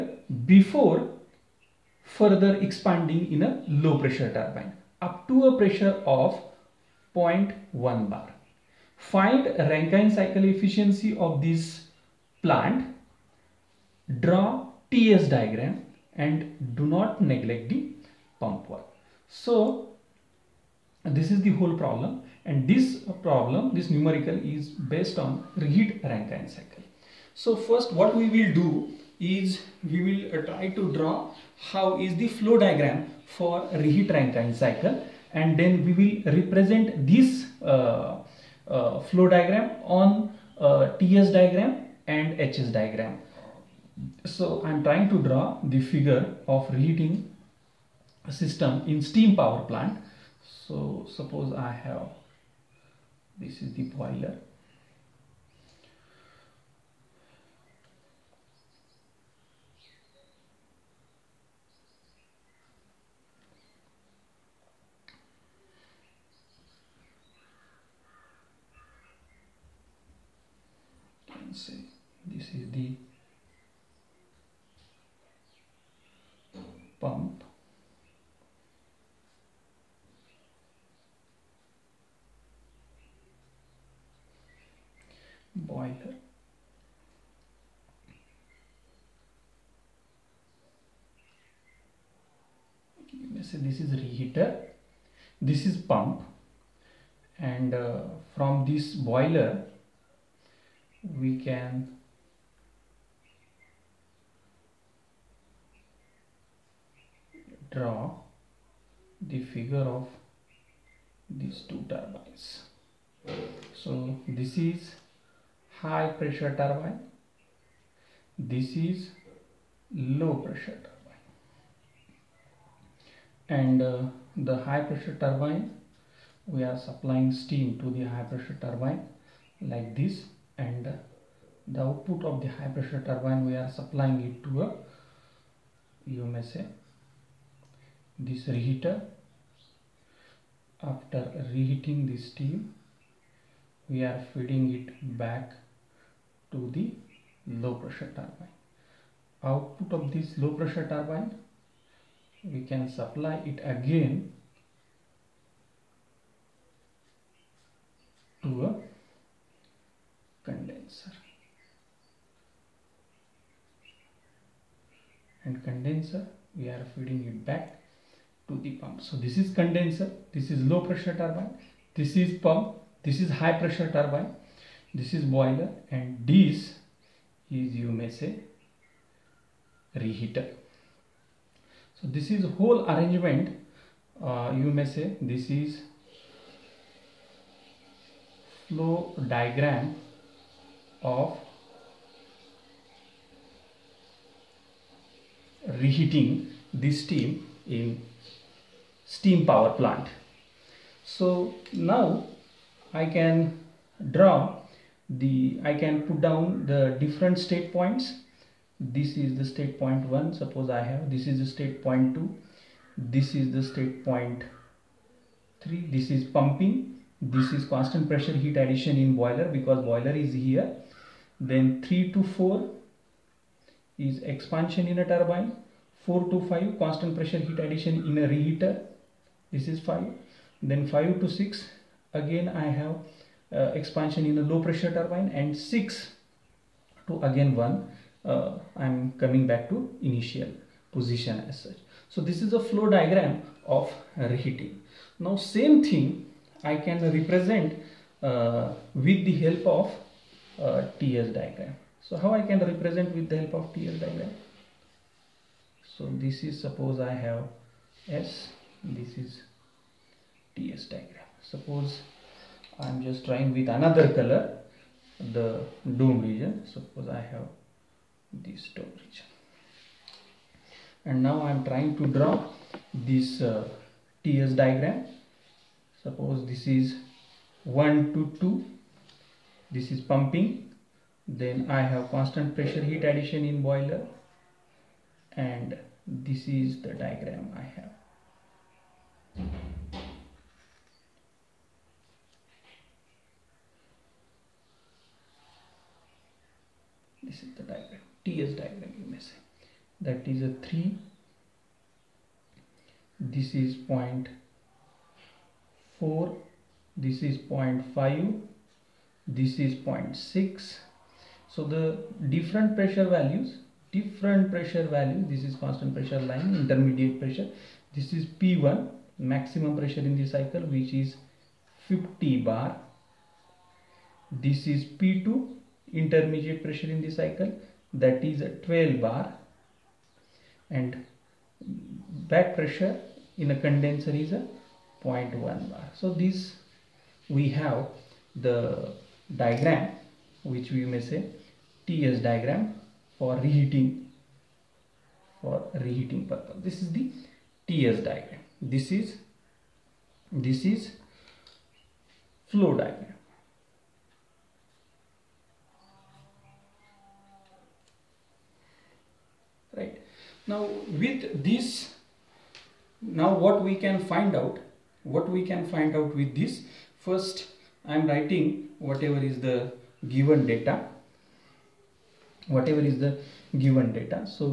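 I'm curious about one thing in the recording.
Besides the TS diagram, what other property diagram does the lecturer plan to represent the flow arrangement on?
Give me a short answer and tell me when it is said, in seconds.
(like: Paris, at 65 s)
HS diagram, at 42 s.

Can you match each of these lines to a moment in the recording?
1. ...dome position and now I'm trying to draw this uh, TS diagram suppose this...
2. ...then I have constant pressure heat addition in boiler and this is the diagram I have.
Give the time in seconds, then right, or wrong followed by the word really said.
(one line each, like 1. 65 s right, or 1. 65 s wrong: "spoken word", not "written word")
1. 268 s wrong: "region", not "position"
2. 281 s right.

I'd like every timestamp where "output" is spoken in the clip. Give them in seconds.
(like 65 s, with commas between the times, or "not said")
131 s, 149 s.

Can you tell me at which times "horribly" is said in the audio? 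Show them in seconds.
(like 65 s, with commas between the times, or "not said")
not said.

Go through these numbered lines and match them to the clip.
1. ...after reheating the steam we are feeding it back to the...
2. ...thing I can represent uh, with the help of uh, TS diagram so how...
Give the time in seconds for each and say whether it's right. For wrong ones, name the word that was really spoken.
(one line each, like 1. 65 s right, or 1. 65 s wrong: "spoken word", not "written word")
1. 140 s right
2. 245 s right.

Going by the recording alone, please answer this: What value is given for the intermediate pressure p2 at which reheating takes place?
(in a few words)
12 bar.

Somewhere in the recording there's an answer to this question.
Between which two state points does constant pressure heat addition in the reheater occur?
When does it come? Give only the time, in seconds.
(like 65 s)
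226 s.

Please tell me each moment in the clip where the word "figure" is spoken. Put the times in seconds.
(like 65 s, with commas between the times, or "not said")
45 s, 109 s.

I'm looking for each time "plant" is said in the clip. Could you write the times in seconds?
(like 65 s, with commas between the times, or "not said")
12 s, 49 s, 199 s.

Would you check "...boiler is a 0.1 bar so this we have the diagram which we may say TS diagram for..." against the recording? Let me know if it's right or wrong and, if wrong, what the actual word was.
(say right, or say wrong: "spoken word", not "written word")
wrong: "condenser", not "boiler".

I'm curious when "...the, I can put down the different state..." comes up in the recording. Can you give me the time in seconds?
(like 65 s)
205 s.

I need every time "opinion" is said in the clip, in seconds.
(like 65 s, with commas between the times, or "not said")
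not said.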